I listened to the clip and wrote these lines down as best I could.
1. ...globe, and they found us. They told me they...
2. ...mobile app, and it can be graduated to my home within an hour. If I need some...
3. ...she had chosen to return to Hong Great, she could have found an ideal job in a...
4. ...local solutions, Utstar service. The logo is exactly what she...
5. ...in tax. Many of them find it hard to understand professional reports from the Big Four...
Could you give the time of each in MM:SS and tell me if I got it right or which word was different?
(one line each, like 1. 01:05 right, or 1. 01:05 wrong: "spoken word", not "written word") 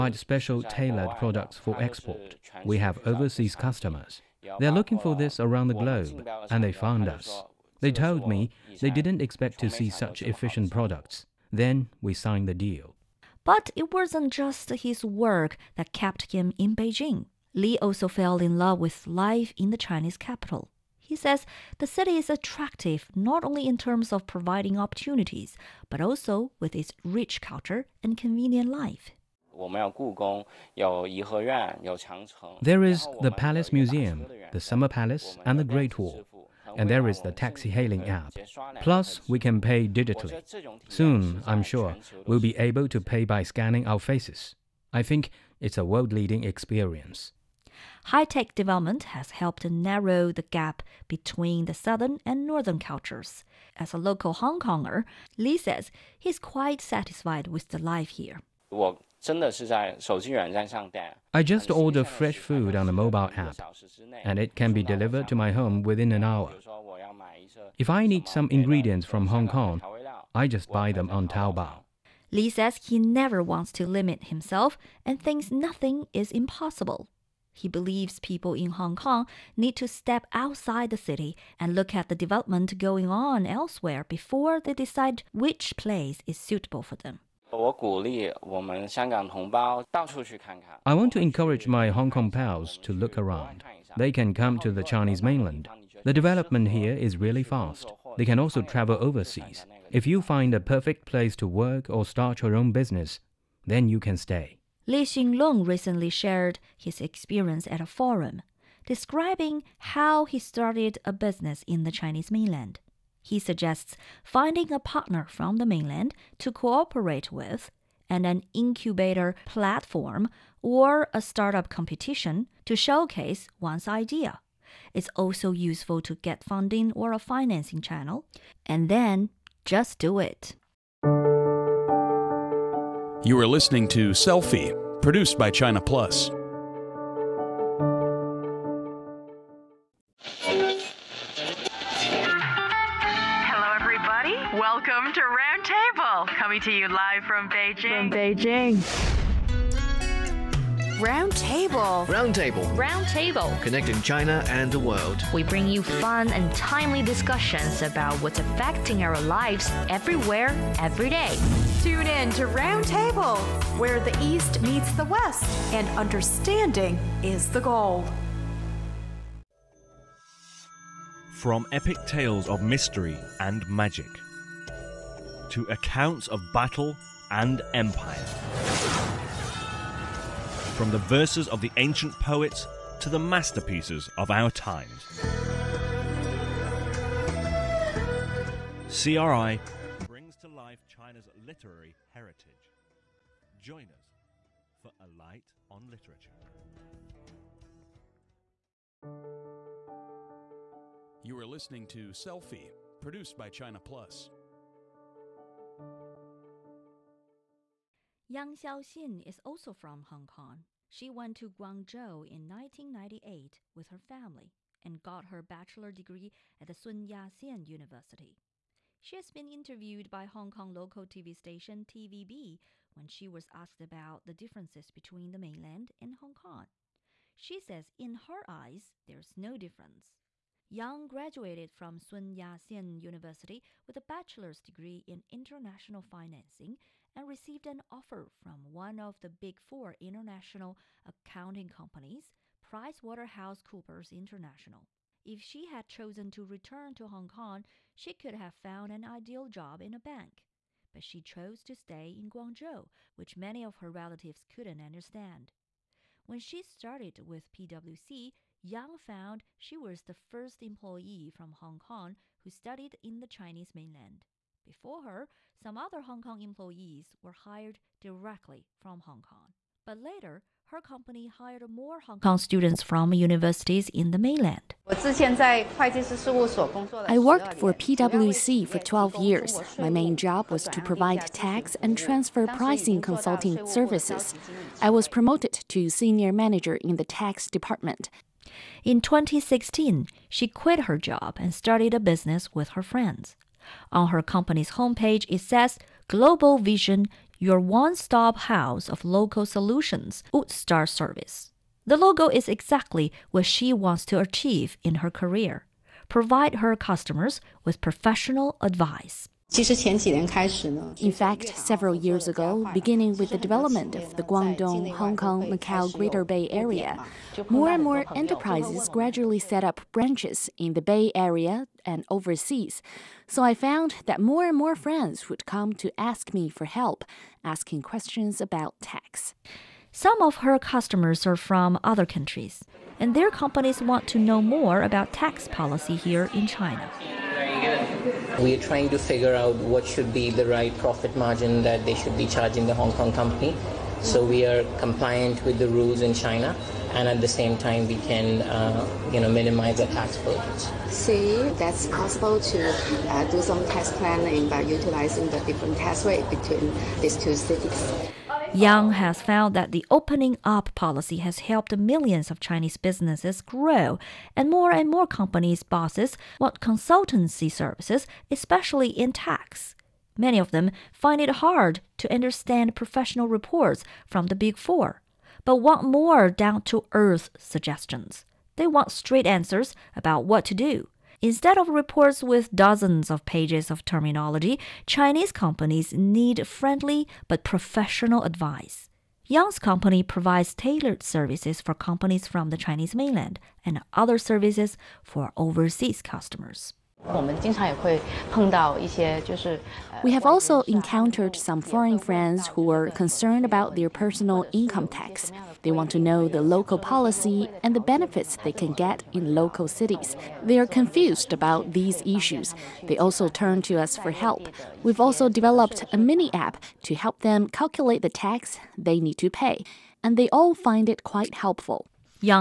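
1. 00:05 right
2. 01:02 wrong: "delivered", not "graduated"
3. 04:05 wrong: "Kong", not "Great"
4. 04:59 right
5. 06:08 right.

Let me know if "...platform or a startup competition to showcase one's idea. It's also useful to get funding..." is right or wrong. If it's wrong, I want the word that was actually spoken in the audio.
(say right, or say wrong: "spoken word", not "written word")
right.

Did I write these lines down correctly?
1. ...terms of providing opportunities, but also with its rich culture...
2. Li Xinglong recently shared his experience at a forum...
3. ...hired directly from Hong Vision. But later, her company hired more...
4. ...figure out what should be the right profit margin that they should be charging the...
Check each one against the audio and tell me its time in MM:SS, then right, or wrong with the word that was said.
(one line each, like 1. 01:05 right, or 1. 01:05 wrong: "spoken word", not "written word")
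1. 00:23 right
2. 01:44 right
3. 04:27 wrong: "Kong", not "Vision"
4. 05:38 right.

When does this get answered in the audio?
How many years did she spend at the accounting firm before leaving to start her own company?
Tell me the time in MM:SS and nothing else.
04:38.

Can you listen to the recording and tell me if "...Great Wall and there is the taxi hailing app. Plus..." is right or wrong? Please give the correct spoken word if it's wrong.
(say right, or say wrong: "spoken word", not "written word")
right.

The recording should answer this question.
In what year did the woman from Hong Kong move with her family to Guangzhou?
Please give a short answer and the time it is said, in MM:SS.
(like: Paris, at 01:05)
1998, at 03:32.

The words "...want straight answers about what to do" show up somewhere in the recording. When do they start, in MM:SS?
06:18.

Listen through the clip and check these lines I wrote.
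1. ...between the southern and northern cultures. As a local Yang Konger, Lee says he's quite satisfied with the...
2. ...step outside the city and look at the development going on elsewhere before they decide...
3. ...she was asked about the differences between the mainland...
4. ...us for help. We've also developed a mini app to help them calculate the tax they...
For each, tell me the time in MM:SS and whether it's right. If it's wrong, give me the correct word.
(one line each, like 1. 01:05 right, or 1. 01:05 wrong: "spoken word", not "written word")
1. 00:51 wrong: "Hong", not "Yang"
2. 01:19 right
3. 03:43 right
4. 06:53 right.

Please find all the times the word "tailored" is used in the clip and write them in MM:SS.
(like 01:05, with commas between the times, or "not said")
00:00, 06:30.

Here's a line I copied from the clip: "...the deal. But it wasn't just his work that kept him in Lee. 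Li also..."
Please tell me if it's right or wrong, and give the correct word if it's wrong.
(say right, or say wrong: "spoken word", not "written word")
wrong: "Beijing", not "Lee".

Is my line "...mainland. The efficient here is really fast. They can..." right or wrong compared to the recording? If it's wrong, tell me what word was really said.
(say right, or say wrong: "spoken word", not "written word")
wrong: "development", not "efficient".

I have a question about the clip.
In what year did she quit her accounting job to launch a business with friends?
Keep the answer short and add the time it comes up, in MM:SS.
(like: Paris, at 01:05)
2016, at 04:49.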